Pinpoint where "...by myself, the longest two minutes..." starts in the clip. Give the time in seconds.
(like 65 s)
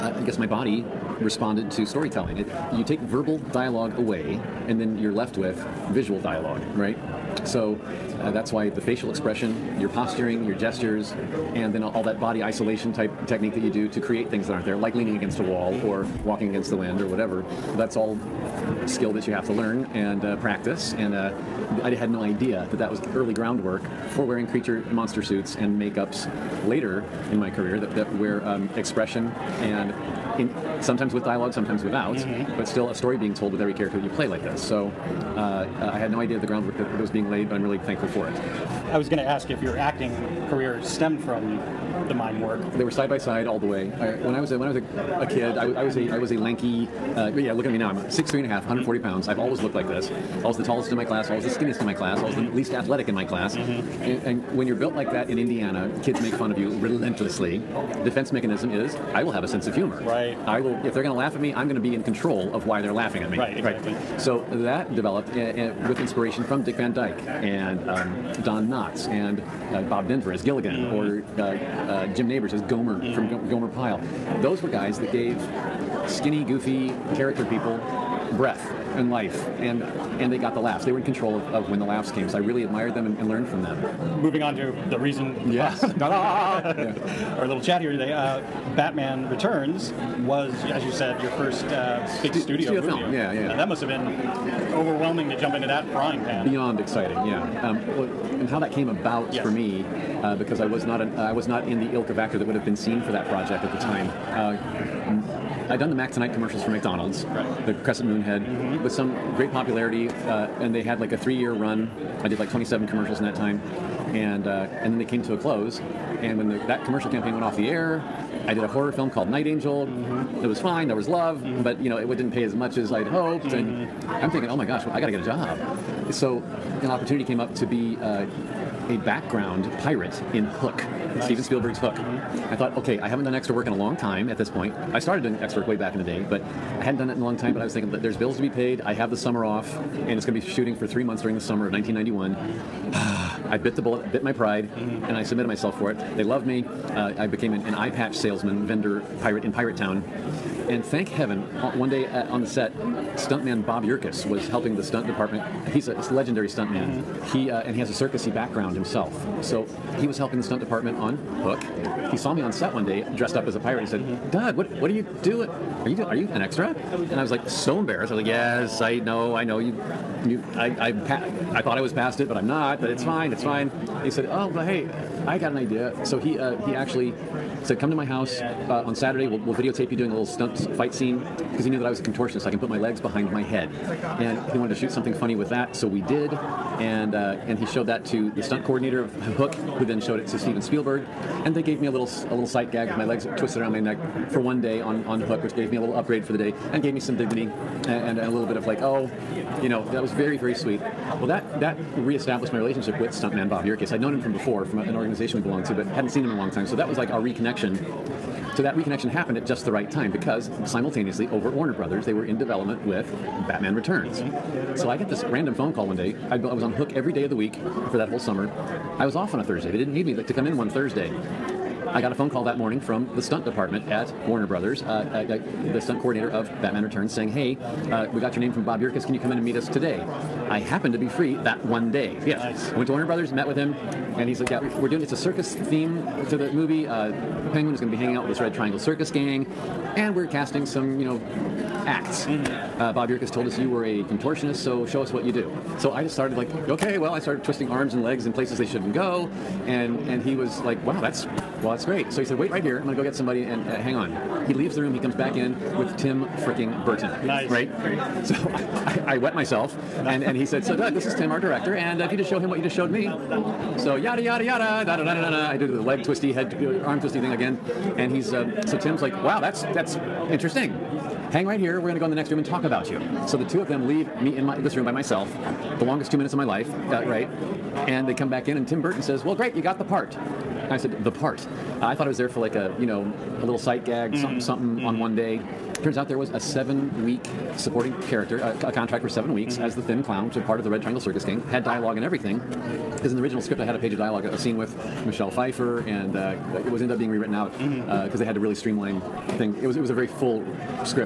274 s.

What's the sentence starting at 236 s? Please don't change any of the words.
Uh, Penguin is going to be hanging out with this Red Triangle Circus gang." And we're casting some, you know, acts.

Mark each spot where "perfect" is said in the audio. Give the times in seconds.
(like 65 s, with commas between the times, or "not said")
not said.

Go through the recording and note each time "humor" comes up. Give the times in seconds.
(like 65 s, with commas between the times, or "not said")
59 s.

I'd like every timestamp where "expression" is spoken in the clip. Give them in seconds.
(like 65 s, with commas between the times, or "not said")
9 s, 28 s.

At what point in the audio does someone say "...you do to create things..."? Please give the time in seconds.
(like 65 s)
13 s.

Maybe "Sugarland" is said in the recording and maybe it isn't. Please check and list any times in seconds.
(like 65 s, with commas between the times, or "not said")
not said.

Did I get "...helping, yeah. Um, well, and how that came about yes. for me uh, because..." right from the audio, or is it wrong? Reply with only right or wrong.
wrong.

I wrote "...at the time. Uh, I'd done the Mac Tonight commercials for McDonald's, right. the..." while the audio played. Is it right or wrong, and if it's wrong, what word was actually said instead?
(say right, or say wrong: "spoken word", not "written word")
right.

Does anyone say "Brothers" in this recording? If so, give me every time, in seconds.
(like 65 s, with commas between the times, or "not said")
211 s, 224 s, 233 s.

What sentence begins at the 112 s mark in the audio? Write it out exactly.
I did like 27 commercials in that time, and uh, and then they came to a close.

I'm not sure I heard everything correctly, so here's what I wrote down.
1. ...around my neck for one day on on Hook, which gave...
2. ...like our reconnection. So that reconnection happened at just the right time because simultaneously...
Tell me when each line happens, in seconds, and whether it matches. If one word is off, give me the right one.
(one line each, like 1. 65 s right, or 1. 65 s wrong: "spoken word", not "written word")
1. 193 s right
2. 206 s right.